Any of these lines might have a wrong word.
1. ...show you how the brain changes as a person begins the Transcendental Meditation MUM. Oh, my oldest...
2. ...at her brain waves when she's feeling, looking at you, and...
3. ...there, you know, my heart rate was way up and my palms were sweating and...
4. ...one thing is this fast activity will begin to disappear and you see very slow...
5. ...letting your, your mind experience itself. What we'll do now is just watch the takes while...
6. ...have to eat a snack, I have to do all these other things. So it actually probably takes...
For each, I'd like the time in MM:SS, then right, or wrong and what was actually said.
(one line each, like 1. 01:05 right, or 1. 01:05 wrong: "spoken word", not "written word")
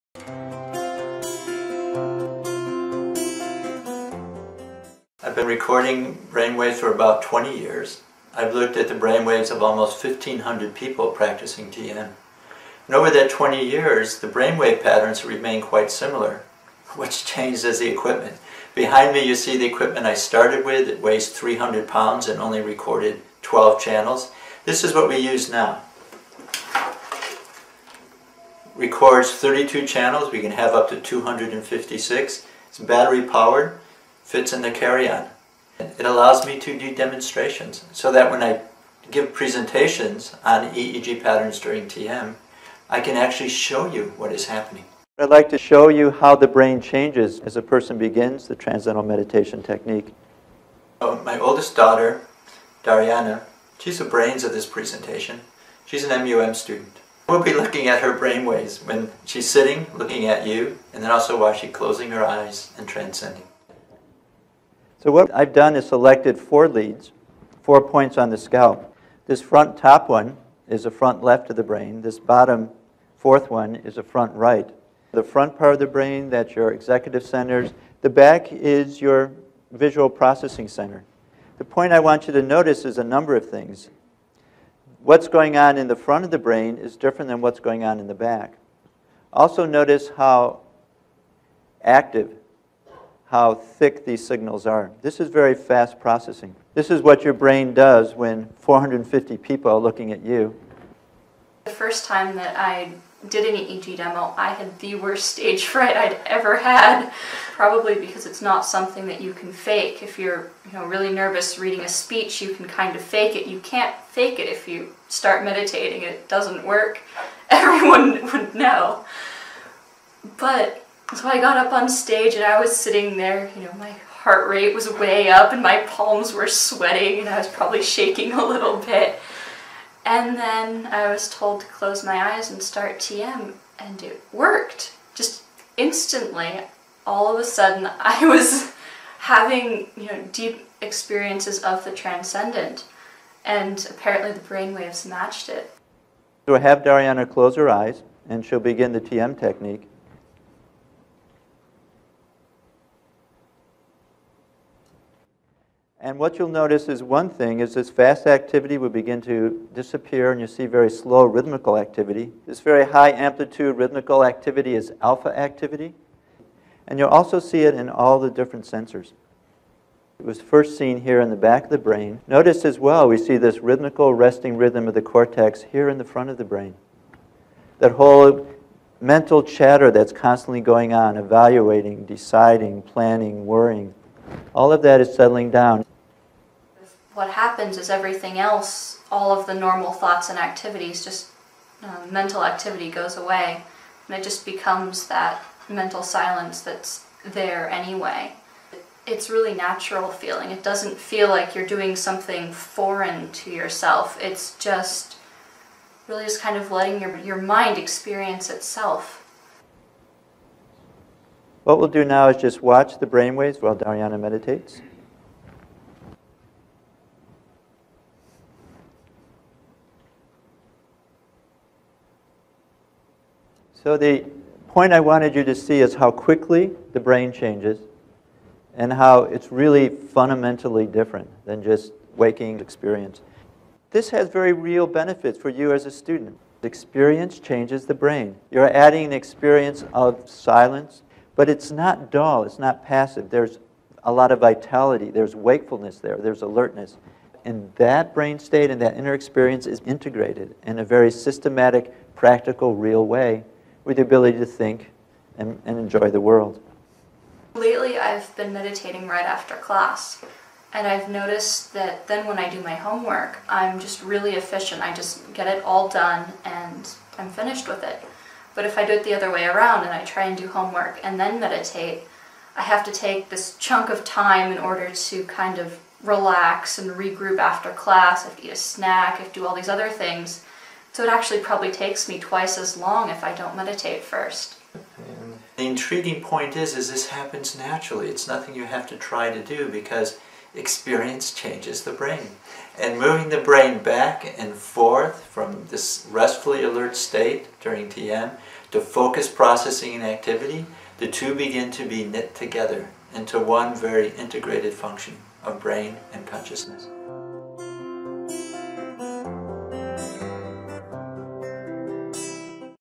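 1. 00:45 wrong: "Technique", not "MUM"
2. 00:57 wrong: "sitting", not "feeling"
3. 02:03 right
4. 02:37 right
5. 03:26 wrong: "brainwaves", not "takes"
6. 04:38 right.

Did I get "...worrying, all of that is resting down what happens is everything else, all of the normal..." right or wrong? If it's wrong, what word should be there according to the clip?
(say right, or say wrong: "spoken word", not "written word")
wrong: "settling", not "resting".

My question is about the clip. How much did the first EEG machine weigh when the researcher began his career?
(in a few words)
300 pounds.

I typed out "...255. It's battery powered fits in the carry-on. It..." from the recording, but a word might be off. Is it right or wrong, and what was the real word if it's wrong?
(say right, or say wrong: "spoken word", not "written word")
wrong: "256", not "255".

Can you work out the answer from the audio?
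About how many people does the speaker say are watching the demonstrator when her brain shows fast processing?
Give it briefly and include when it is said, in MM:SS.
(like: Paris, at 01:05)
450, at 01:38.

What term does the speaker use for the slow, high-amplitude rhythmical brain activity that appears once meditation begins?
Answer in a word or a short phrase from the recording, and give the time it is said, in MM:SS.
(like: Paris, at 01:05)
alpha activity, at 02:44.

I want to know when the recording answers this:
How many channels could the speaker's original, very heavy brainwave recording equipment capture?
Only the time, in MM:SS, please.
00:23.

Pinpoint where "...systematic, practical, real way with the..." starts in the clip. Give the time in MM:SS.
04:11.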